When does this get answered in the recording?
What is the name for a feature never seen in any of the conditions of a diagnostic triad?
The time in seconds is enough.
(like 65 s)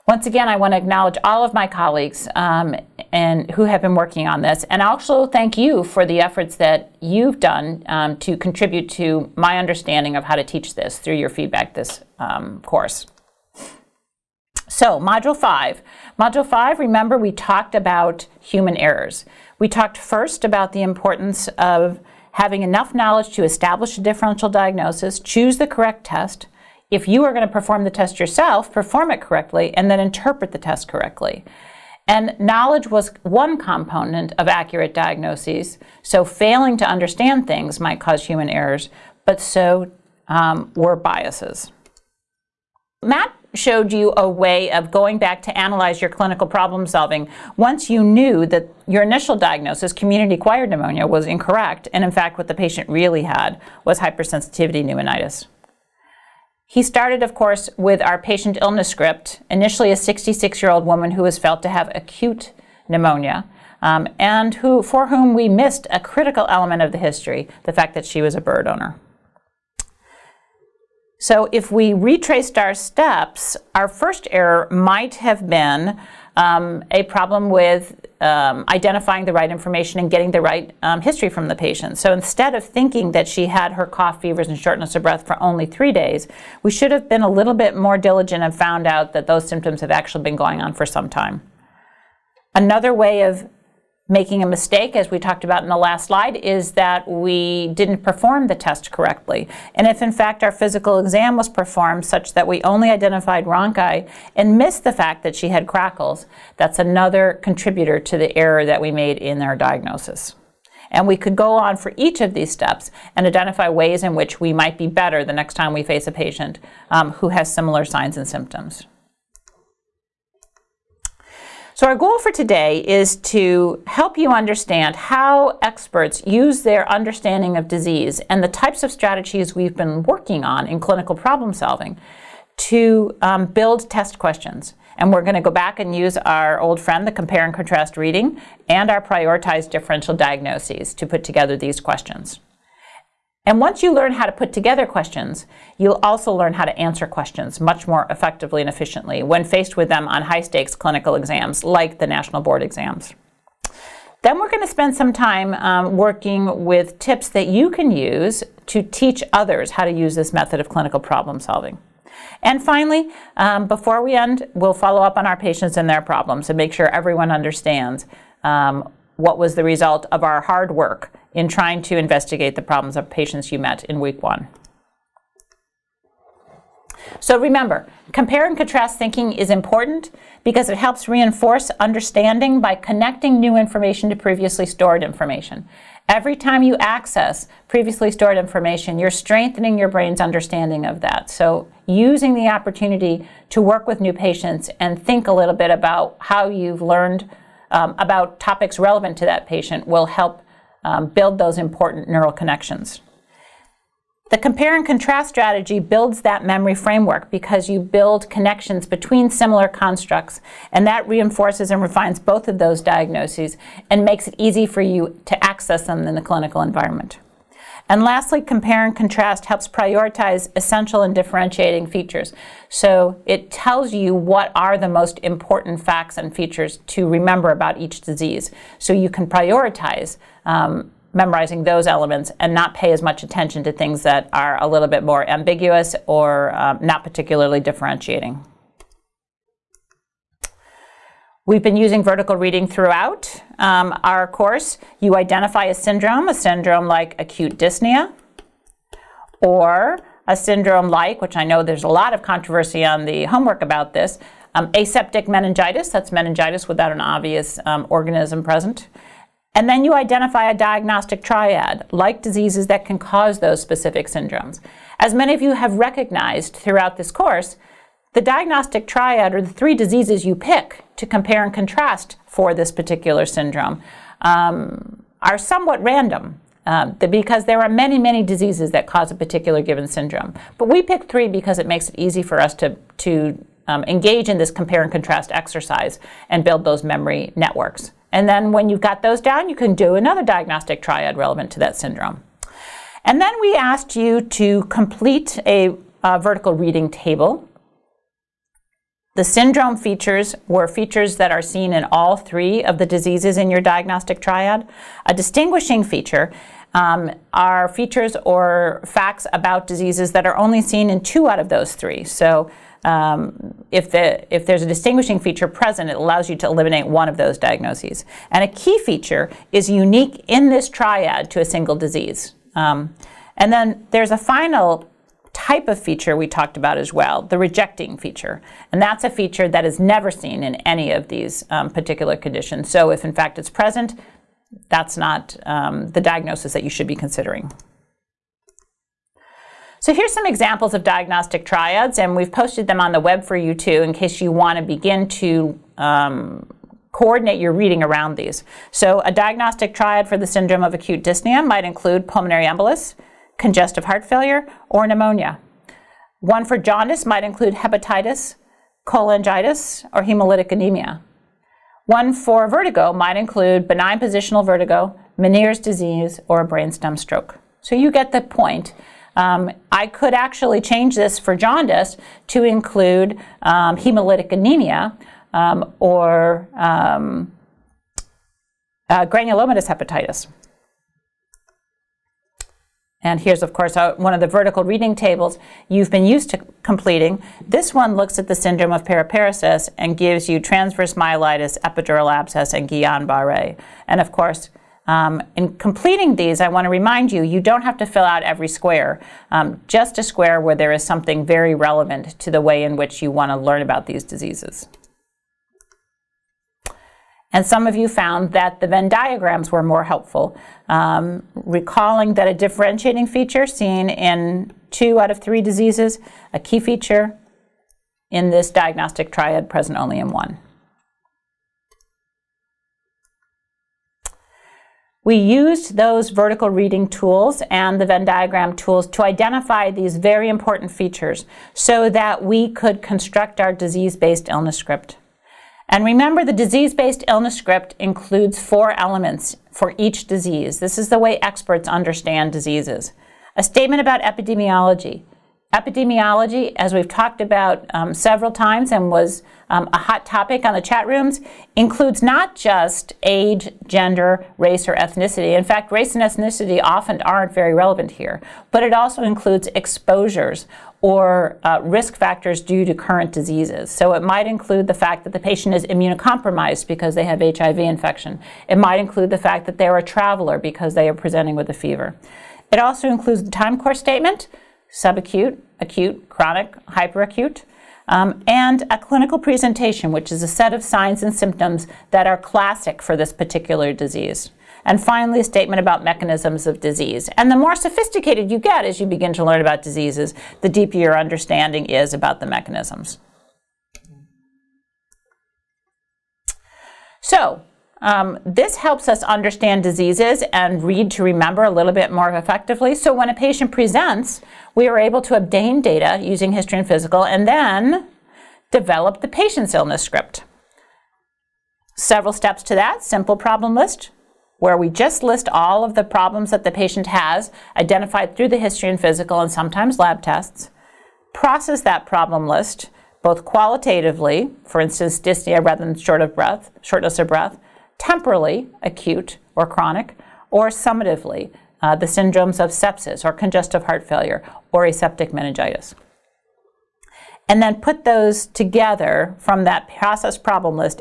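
327 s.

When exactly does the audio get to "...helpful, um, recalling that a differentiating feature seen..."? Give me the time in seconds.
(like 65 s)
409 s.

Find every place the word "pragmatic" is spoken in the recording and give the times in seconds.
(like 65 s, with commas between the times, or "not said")
not said.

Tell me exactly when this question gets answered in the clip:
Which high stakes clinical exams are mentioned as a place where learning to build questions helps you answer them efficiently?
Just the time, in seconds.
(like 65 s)
151 s.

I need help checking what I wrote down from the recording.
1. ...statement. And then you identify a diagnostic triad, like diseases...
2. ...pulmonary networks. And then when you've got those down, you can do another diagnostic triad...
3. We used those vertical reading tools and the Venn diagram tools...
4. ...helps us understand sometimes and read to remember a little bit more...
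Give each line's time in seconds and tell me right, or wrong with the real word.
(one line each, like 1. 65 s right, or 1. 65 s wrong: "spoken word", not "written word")
1. 258 s wrong: "present", not "statement"
2. 286 s wrong: "memory", not "pulmonary"
3. 425 s right
4. 498 s wrong: "diseases", not "sometimes".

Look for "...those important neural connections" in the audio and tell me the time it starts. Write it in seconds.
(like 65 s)
201 s.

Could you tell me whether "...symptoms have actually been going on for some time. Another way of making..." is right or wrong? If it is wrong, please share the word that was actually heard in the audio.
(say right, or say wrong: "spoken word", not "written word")
right.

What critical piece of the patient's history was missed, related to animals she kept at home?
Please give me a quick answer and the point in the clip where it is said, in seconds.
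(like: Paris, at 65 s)
She was a bird owner, at 68 s.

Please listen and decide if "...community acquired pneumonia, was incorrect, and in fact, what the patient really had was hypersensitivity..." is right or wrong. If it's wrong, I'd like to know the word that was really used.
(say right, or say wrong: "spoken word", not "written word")
right.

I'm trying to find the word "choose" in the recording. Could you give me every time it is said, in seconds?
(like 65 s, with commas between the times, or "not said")
25 s.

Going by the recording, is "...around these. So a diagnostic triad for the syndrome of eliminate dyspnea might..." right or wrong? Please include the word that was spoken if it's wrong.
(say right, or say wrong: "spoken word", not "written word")
wrong: "acute", not "eliminate".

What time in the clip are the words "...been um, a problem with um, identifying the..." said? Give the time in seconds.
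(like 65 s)
75 s.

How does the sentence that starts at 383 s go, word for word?
And here's, of course, one of the vertical reading tables you've been used to completing.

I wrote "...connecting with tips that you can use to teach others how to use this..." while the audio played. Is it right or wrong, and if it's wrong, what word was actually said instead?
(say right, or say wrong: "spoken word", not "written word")
wrong: "working", not "connecting".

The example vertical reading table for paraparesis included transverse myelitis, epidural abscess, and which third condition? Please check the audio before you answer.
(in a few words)
Guillain-Barré.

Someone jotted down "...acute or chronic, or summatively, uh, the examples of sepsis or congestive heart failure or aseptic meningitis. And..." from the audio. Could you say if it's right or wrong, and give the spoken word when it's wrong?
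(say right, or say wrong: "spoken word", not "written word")
wrong: "syndromes", not "examples".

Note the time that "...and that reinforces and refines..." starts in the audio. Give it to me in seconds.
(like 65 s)
210 s.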